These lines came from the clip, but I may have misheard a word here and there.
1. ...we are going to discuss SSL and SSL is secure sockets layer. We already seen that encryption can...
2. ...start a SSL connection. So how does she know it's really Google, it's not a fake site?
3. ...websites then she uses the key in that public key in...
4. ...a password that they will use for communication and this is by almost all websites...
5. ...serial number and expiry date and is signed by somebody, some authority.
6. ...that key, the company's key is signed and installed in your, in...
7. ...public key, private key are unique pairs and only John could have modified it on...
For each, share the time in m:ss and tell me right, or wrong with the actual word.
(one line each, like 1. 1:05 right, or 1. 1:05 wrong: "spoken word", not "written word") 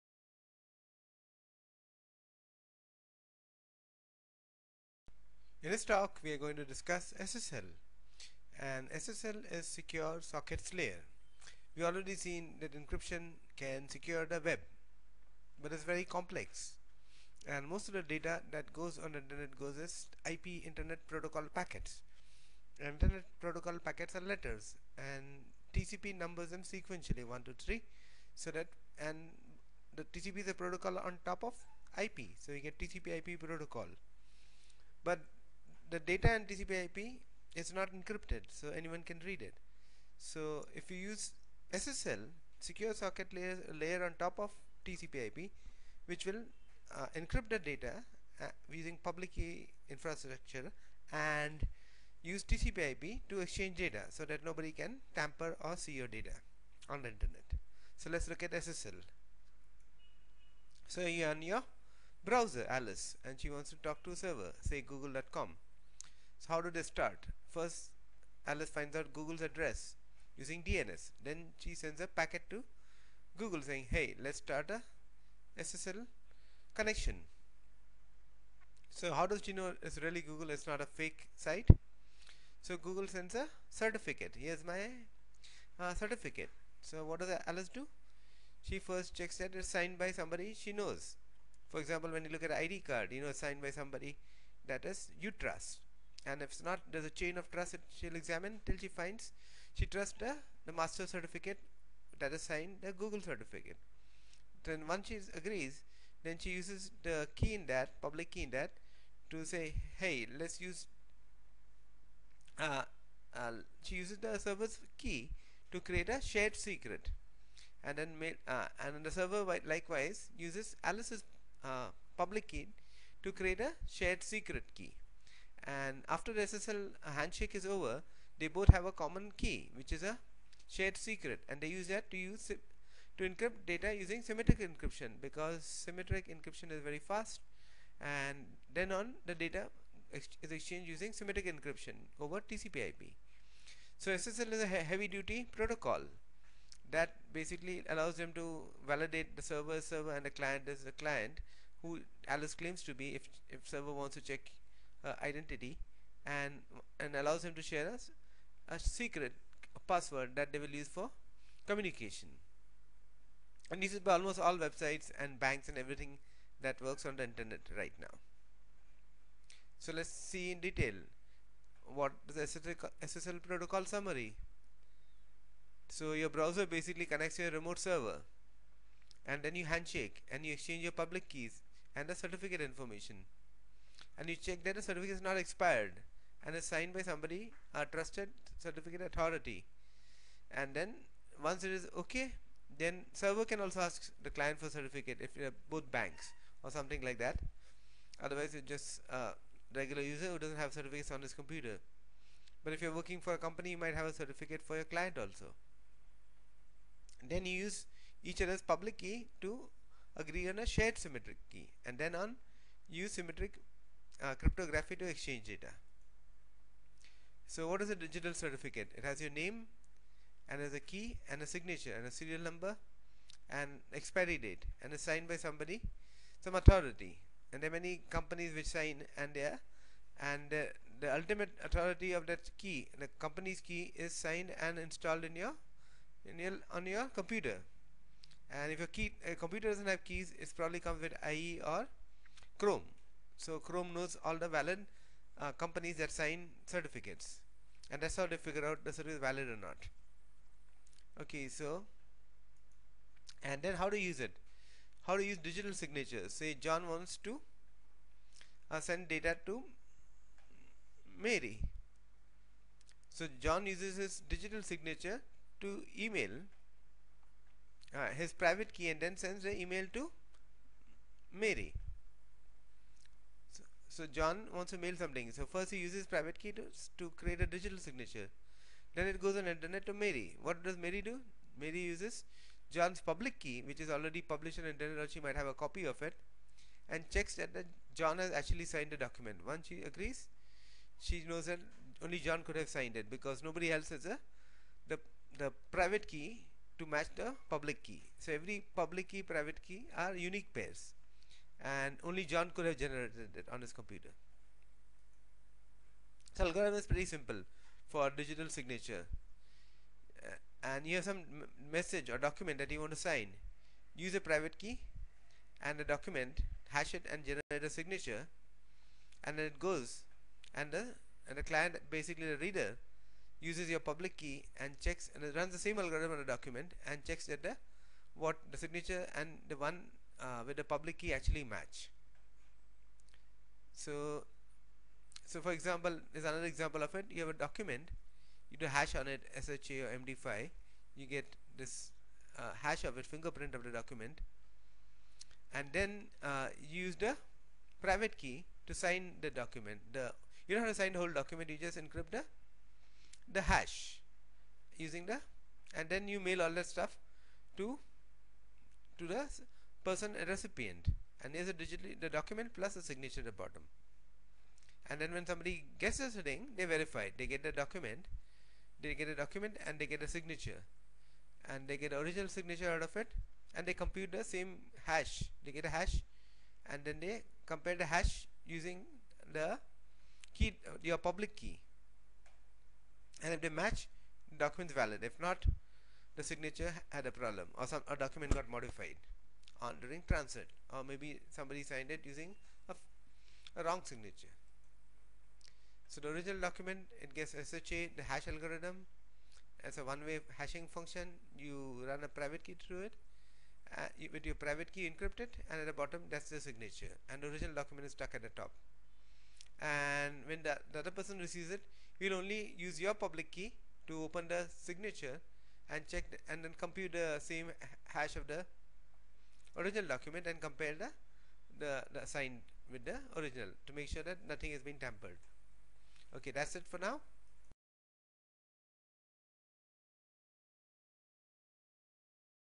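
1. 0:06 right
2. 1:14 right
3. 1:45 wrong: "agrees", not "websites"
4. 2:39 right
5. 3:42 right
6. 3:52 right
7. 4:58 wrong: "generated", not "modified".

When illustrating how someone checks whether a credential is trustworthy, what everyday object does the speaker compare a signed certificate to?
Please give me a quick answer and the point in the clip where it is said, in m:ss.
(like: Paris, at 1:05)
ID card, at 1:32.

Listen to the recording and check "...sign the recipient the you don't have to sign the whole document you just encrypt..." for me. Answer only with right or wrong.
wrong.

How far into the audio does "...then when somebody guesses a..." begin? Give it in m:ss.
6:04.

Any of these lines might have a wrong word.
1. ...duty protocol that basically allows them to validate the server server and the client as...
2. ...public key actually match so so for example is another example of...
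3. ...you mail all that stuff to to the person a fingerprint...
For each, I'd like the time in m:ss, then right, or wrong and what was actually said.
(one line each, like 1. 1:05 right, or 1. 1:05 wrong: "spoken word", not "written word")
1. 2:25 right
2. 5:30 right
3. 5:56 wrong: "recipient", not "fingerprint".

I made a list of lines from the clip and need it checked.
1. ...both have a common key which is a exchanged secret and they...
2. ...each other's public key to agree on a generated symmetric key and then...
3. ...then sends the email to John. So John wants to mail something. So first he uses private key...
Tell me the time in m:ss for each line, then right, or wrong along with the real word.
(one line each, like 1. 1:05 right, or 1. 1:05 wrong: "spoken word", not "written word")
1. 2:08 wrong: "shared", not "exchanged"
2. 3:28 wrong: "shared", not "generated"
3. 4:28 wrong: "Mary", not "John".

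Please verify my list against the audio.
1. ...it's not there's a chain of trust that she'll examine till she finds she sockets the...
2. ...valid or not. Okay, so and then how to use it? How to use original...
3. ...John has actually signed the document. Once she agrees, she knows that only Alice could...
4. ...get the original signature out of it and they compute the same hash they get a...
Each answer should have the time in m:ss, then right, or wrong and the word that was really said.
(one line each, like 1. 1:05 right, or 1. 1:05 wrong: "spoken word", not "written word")
1. 1:36 wrong: "trusts", not "sockets"
2. 4:09 wrong: "digital", not "original"
3. 4:47 wrong: "John", not "Alice"
4. 6:11 right.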